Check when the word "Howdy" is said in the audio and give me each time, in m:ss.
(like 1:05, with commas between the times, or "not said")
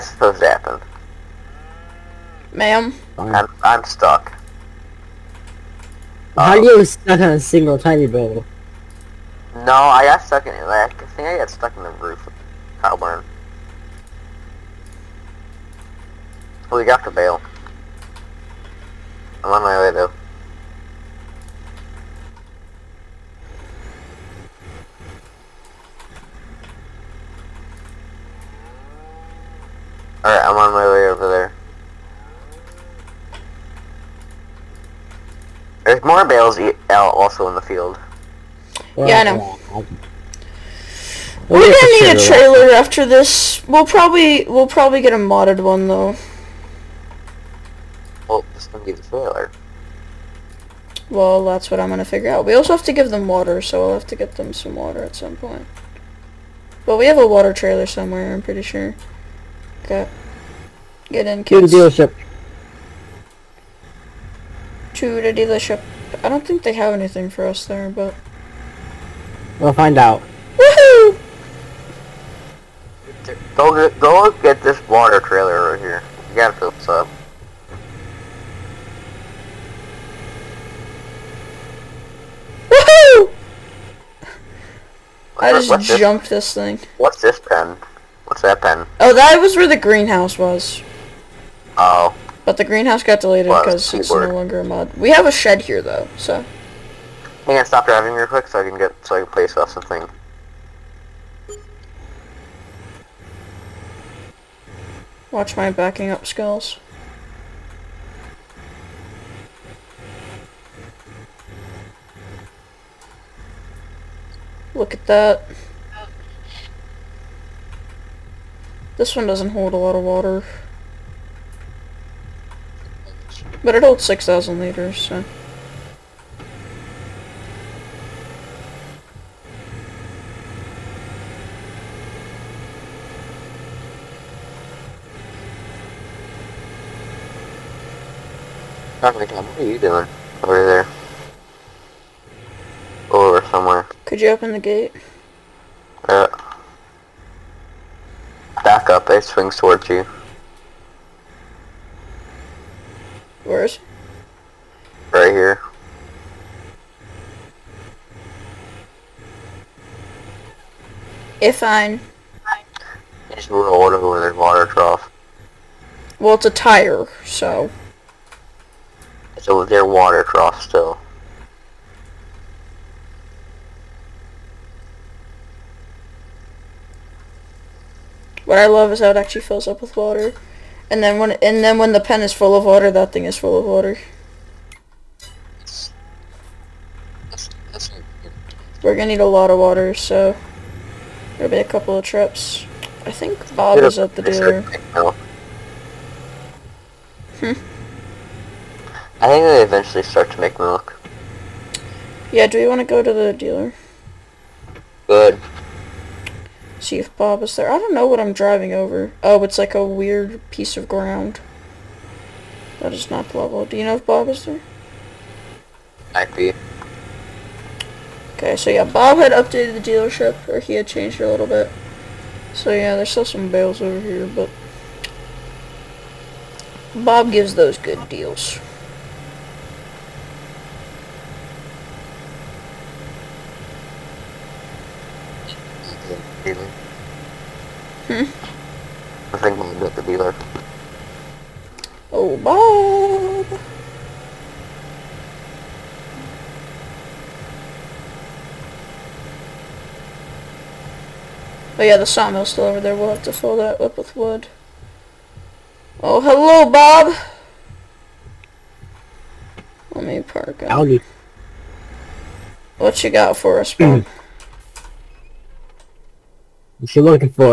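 4:20.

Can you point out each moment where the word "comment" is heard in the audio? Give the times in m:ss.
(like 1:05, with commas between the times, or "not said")
not said.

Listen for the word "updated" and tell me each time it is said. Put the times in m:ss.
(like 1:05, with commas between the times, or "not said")
3:39.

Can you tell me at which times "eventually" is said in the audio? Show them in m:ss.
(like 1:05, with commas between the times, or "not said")
3:19.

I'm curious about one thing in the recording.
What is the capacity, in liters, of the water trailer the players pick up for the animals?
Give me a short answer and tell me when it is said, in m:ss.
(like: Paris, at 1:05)
6,000 liters, at 2:04.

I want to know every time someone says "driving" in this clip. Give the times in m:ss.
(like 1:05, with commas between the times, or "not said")
1:37, 3:28.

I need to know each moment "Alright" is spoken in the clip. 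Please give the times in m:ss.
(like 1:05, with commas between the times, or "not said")
0:30.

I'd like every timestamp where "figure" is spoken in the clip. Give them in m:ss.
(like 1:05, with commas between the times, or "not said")
0:52.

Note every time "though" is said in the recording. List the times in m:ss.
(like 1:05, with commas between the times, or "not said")
0:19, 0:45, 1:35.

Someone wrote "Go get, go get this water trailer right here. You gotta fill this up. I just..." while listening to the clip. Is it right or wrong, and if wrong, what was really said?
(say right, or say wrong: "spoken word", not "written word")
right.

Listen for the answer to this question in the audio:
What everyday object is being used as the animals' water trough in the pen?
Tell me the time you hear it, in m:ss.
2:46.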